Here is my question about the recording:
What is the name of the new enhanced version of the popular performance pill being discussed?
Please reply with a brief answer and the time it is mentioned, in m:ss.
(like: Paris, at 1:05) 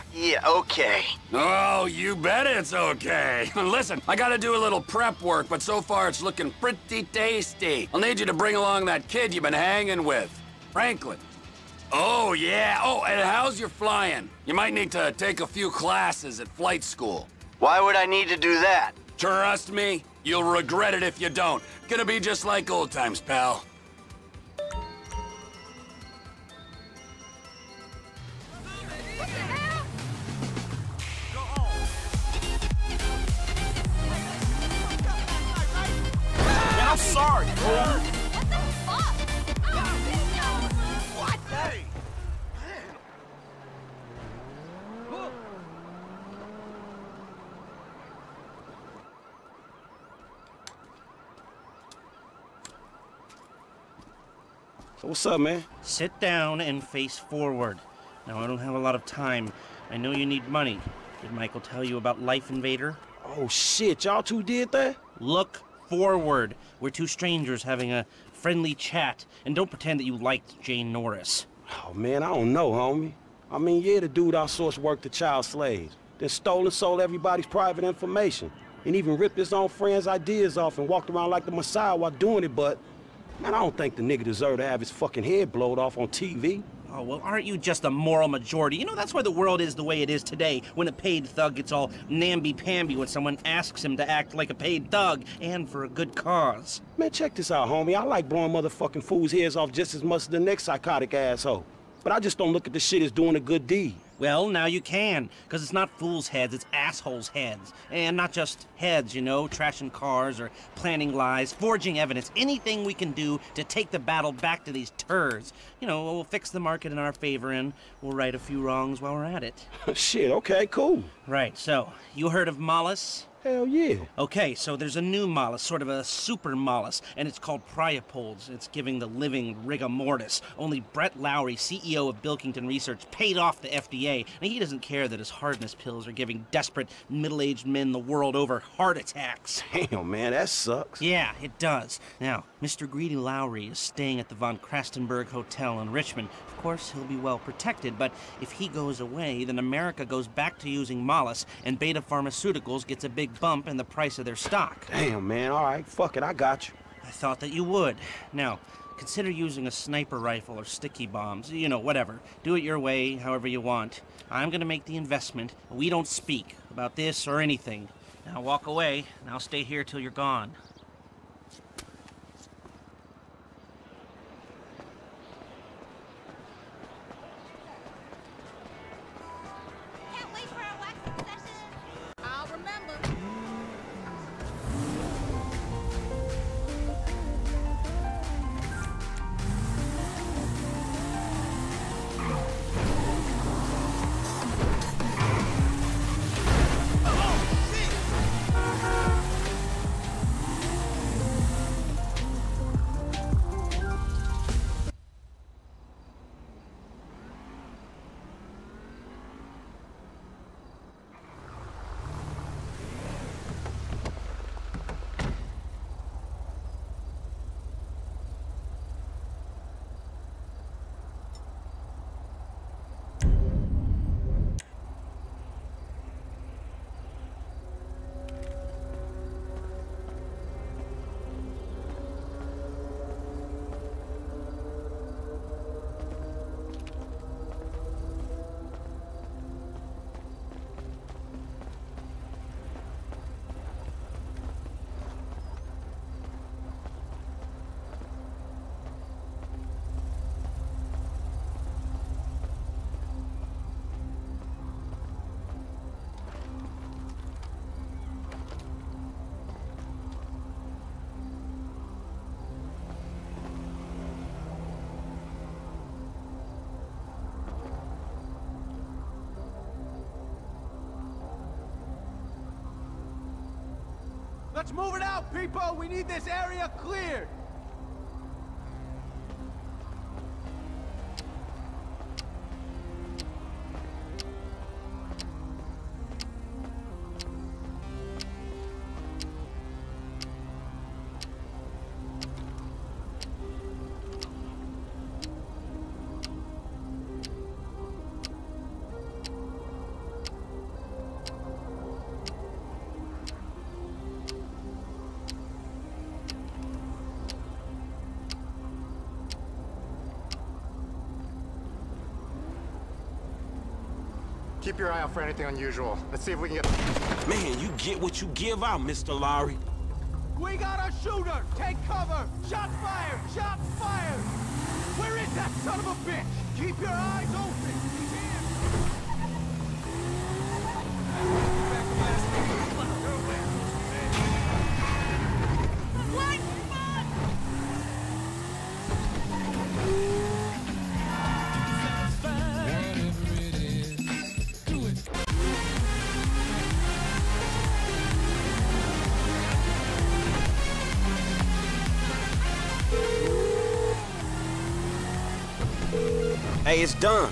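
Priapoles, at 2:07.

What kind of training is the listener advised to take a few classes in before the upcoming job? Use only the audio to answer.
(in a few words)
Flight school.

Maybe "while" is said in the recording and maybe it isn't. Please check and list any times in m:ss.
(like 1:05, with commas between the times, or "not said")
1:21, 1:58.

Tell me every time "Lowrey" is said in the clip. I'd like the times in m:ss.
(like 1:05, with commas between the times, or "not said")
2:11, 2:23, 5:19.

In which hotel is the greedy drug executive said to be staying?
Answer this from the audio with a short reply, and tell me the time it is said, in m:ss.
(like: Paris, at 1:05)
Von Crastenburg Hotel, at 2:24.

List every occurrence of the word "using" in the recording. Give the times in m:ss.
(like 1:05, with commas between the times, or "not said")
2:30, 2:39.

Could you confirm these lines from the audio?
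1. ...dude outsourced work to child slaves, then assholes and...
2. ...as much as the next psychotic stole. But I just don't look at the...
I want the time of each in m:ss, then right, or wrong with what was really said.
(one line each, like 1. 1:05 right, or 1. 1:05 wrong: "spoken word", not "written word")
1. 1:14 wrong: "stole", not "assholes"
2. 1:39 wrong: "asshole", not "stole".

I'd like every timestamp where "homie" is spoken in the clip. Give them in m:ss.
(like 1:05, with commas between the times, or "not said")
1:12, 1:37.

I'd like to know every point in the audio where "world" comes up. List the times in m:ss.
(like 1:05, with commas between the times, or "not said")
1:29, 2:17.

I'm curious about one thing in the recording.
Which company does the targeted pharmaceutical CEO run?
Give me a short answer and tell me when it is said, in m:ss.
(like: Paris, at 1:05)
Bilkington Research, at 2:12.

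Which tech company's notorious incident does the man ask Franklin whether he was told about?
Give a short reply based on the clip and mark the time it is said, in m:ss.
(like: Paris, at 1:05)
Life Invader, at 1:02.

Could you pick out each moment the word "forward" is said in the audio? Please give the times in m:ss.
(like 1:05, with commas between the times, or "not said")
0:57, 1:05.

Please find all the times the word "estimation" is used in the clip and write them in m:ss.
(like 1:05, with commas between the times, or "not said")
not said.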